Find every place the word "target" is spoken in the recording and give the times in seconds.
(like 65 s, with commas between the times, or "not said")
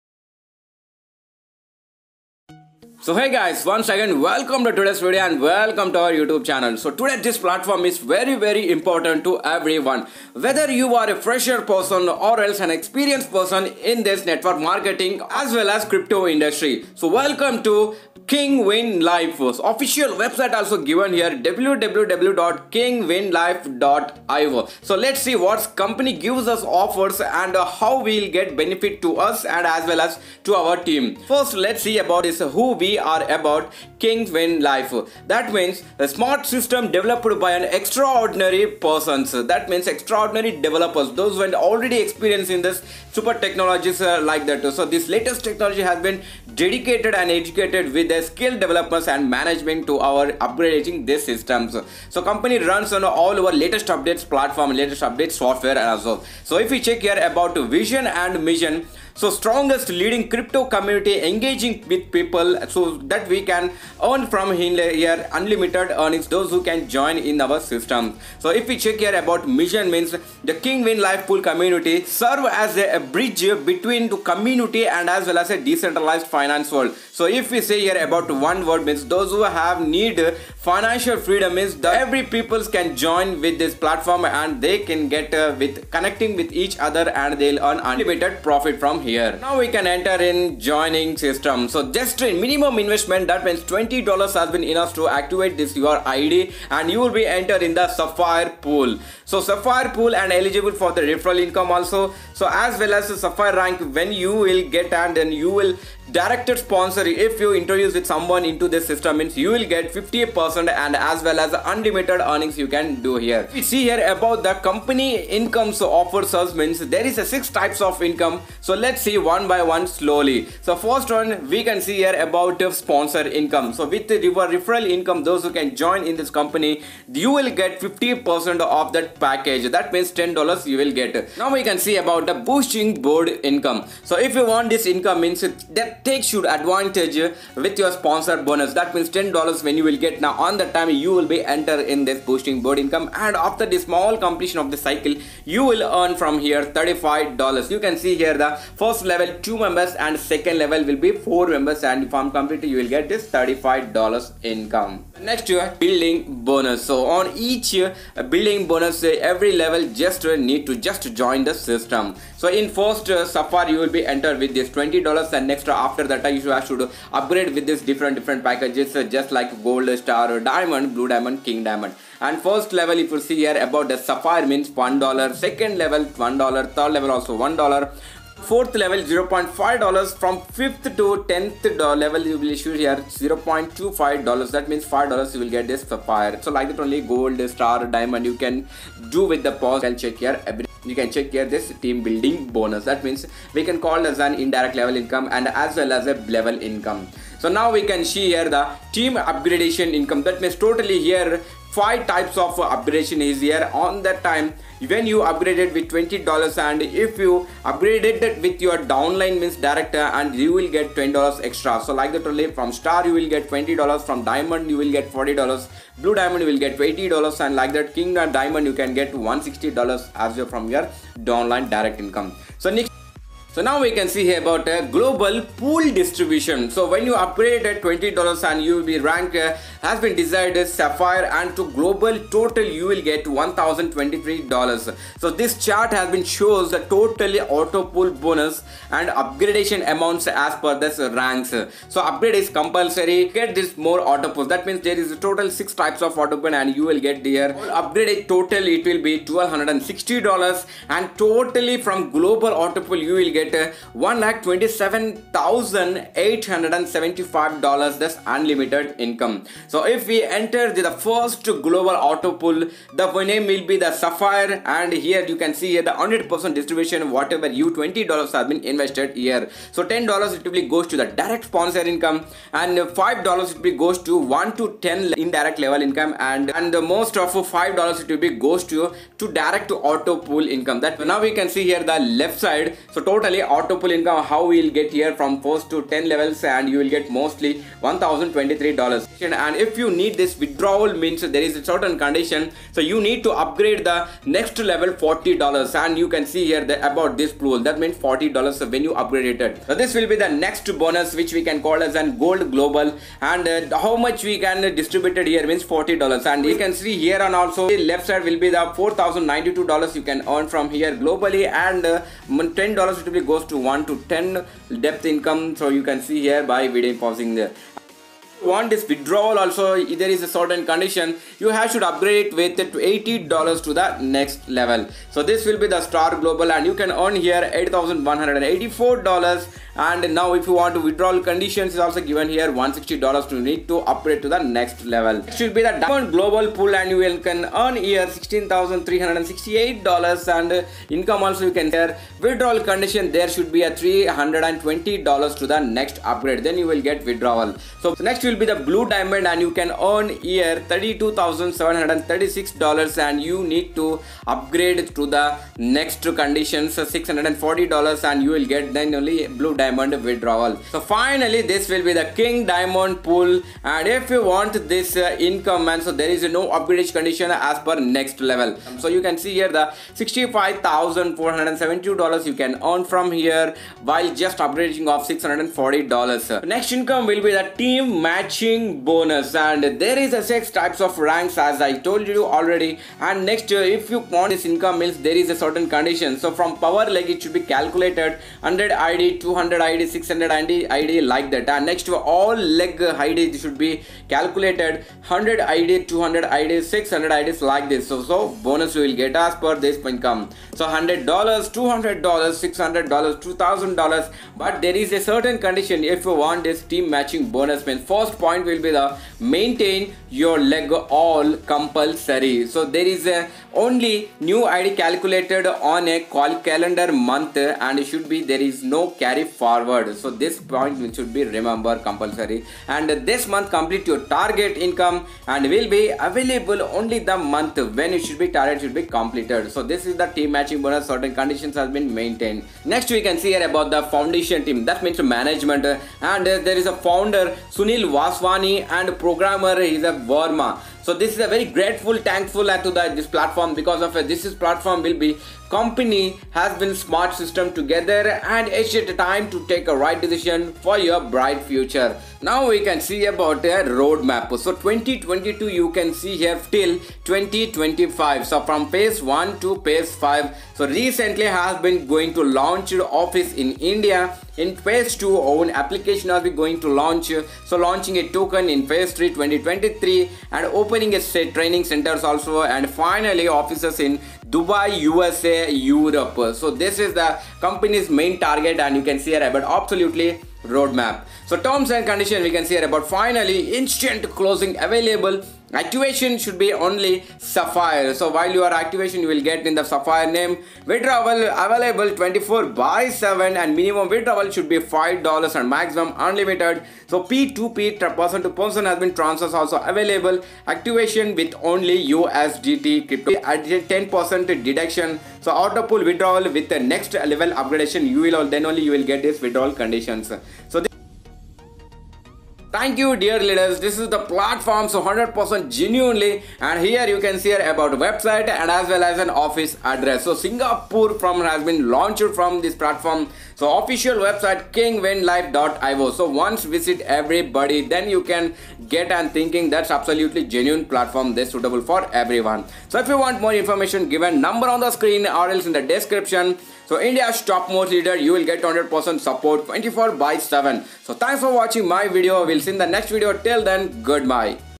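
424 s, 428 s, 478 s.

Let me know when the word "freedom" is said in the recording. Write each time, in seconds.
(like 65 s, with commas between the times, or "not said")
81 s.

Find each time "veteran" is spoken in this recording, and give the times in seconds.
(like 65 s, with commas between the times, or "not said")
not said.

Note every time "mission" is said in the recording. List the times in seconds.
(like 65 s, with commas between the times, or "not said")
58 s, 69 s.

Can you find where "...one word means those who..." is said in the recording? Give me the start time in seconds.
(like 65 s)
78 s.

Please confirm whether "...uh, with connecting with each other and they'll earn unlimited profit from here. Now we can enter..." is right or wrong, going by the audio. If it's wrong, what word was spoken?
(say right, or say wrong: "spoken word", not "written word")
right.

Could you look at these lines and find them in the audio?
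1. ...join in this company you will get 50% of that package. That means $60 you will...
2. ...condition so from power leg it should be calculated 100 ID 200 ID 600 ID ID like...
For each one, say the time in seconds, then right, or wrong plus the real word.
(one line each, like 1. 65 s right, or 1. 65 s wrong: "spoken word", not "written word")
1. 125 s wrong: "10", not "60"
2. 385 s right.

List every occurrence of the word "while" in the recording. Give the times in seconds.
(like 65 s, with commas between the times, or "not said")
373 s, 488 s.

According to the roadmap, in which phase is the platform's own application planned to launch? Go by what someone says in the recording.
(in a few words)
Phase 2.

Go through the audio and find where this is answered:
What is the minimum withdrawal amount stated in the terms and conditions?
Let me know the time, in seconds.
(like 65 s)
494 s.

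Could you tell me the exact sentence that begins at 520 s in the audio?
So Singapore from has been launched from this platform.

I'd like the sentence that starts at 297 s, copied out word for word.
That means $40 when you upgrade it.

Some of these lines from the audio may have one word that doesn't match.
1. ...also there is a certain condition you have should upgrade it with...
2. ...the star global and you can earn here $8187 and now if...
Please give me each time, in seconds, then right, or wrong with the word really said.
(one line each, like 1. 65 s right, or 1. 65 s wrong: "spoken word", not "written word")
1. 319 s right
2. 325 s wrong: "8184", not "8187".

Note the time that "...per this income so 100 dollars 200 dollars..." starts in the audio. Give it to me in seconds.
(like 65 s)
399 s.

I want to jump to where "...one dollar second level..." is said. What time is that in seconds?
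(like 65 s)
174 s.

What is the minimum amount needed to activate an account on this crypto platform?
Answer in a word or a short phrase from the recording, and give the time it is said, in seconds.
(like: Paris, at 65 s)
$20, at 93 s.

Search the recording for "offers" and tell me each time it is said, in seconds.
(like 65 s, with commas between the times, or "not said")
26 s, 115 s.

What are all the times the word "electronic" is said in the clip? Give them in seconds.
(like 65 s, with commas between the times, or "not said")
not said.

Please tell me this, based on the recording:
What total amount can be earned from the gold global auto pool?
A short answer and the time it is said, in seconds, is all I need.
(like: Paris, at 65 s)
$4,092, at 308 s.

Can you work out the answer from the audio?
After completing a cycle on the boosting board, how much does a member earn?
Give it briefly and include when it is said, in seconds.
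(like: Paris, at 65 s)
$35, at 145 s.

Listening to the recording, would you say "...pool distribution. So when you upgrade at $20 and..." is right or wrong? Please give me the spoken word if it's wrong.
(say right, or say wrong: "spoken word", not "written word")
right.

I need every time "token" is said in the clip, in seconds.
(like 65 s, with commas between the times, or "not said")
468 s.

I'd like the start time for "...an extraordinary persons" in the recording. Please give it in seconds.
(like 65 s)
37 s.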